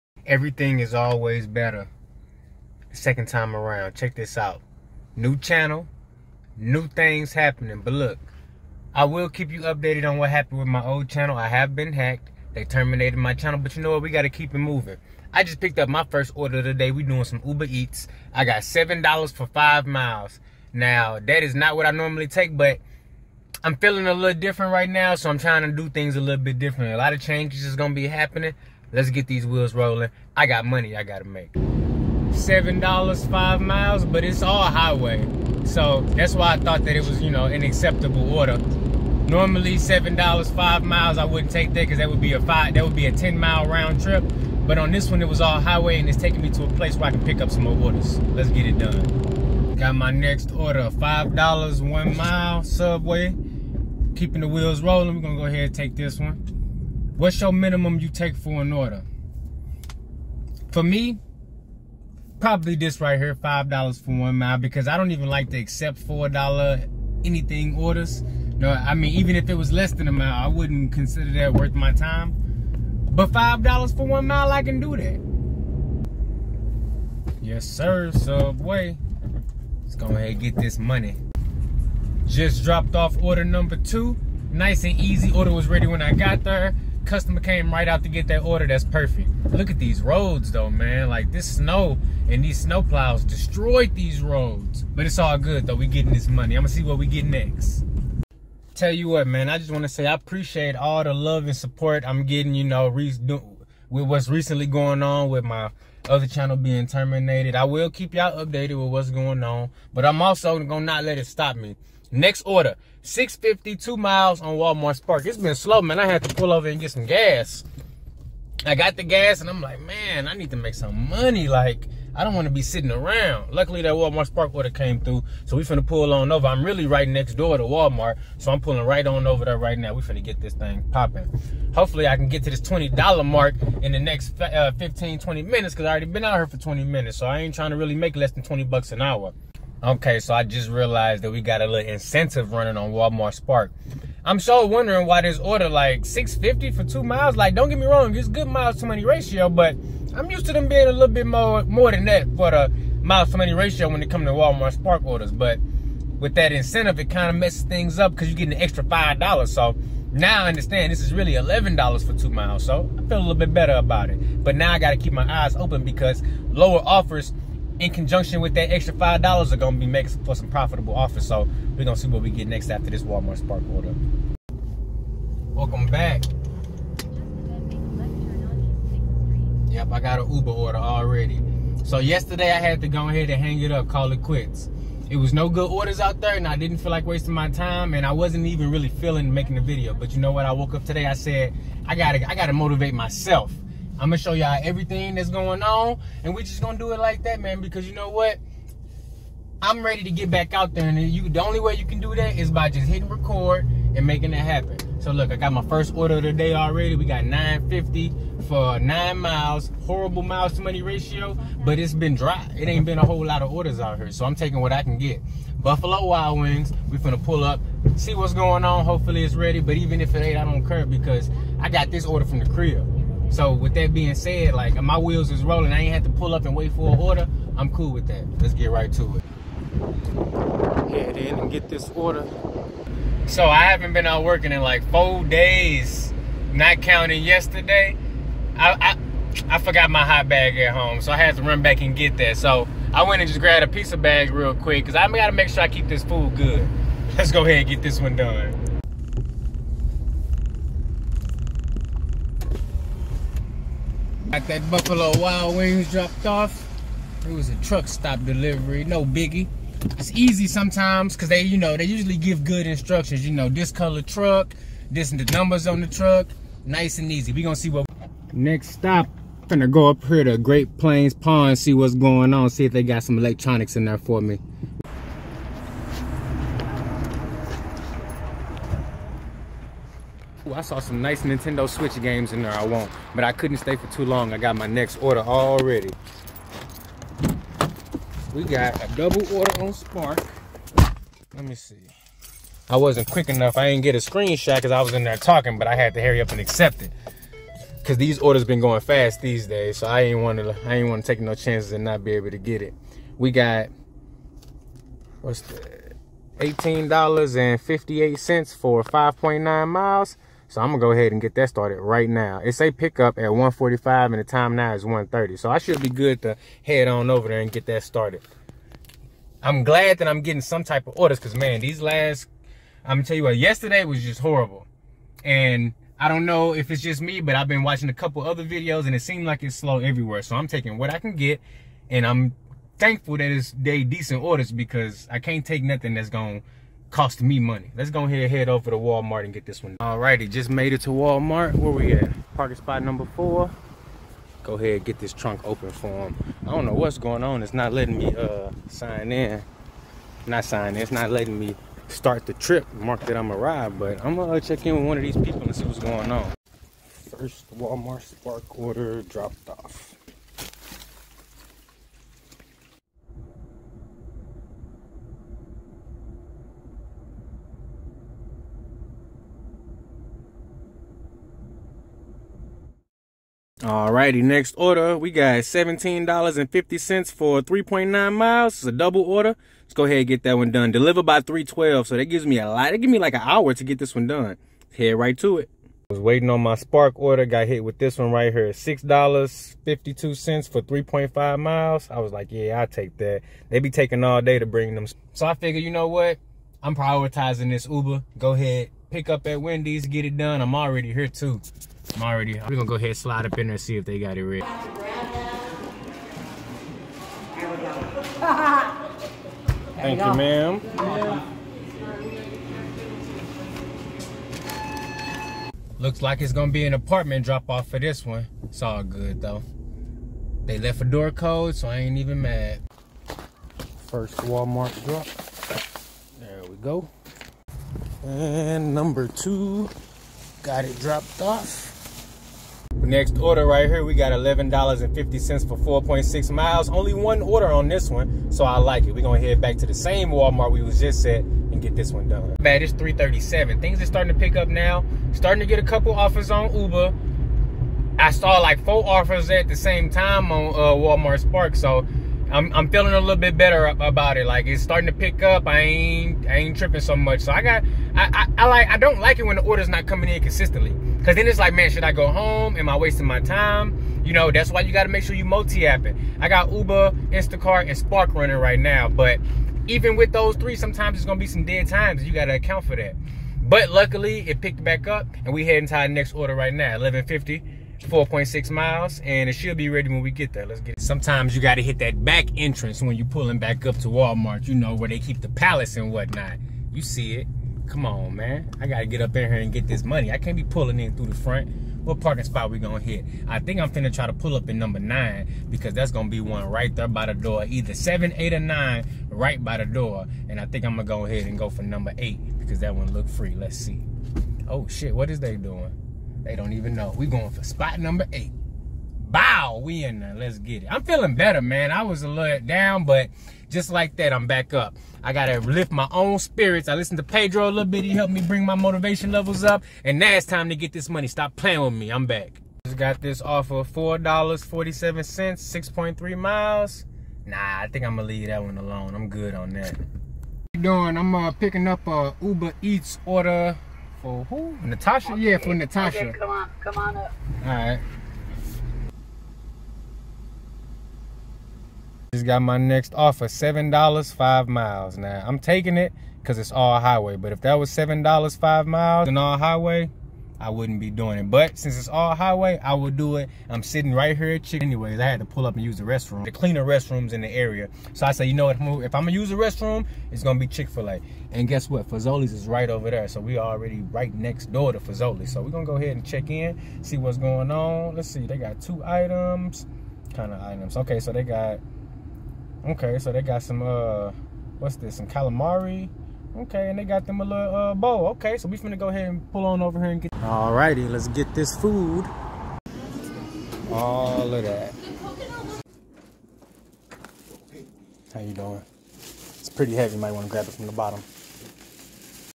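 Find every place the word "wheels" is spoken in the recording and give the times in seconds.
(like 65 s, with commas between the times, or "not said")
29 s, 54 s, 224 s.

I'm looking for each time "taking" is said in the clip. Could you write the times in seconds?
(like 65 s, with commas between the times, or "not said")
46 s, 214 s, 330 s, 393 s, 545 s.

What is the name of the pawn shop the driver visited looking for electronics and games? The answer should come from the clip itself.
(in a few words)
Great Plains Pawn.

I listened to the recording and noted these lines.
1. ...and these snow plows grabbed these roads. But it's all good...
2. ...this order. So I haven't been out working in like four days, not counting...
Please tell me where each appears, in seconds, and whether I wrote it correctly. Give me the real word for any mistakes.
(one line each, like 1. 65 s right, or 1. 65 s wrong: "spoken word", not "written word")
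1. 92 s wrong: "destroyed", not "grabbed"
2. 231 s right.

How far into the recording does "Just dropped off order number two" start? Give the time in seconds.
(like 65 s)
82 s.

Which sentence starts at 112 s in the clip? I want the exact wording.
Next order, 652 miles on Walmart Spark.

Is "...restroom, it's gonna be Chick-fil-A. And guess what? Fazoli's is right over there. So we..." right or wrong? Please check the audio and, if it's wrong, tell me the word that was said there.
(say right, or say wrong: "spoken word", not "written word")
right.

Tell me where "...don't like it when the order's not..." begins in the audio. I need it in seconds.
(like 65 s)
458 s.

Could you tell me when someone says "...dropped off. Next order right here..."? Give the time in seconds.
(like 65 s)
430 s.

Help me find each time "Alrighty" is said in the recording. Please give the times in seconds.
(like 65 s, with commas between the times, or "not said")
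339 s, 373 s, 580 s.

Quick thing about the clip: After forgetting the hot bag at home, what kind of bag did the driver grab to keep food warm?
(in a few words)
Pizza bag.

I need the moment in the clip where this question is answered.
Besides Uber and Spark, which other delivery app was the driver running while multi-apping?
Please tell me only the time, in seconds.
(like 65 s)
467 s.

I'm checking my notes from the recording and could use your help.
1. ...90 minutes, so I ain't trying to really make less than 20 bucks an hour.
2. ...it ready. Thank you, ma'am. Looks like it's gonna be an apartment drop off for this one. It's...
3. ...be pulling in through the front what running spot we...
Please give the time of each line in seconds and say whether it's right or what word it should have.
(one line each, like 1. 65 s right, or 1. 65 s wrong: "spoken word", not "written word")
1. 136 s wrong: "20", not "90"
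2. 404 s right
3. 490 s wrong: "parking", not "running".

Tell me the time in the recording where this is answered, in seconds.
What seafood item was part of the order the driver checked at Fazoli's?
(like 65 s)
575 s.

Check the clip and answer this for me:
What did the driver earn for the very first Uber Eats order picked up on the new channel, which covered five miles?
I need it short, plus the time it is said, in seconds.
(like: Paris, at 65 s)
$7, at 18 s.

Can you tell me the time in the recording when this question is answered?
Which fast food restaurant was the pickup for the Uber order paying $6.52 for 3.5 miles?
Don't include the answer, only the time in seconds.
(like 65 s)
399 s.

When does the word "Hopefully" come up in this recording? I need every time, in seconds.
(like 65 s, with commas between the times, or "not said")
131 s, 218 s.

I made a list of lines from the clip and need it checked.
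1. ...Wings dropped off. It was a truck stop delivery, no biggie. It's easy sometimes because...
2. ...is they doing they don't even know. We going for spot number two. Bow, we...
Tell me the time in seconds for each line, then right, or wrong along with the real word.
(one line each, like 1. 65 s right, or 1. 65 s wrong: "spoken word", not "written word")
1. 255 s right
2. 505 s wrong: "eight", not "two".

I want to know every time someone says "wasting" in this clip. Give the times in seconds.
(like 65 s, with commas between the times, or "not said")
187 s, 462 s.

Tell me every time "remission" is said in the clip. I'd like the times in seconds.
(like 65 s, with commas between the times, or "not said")
not said.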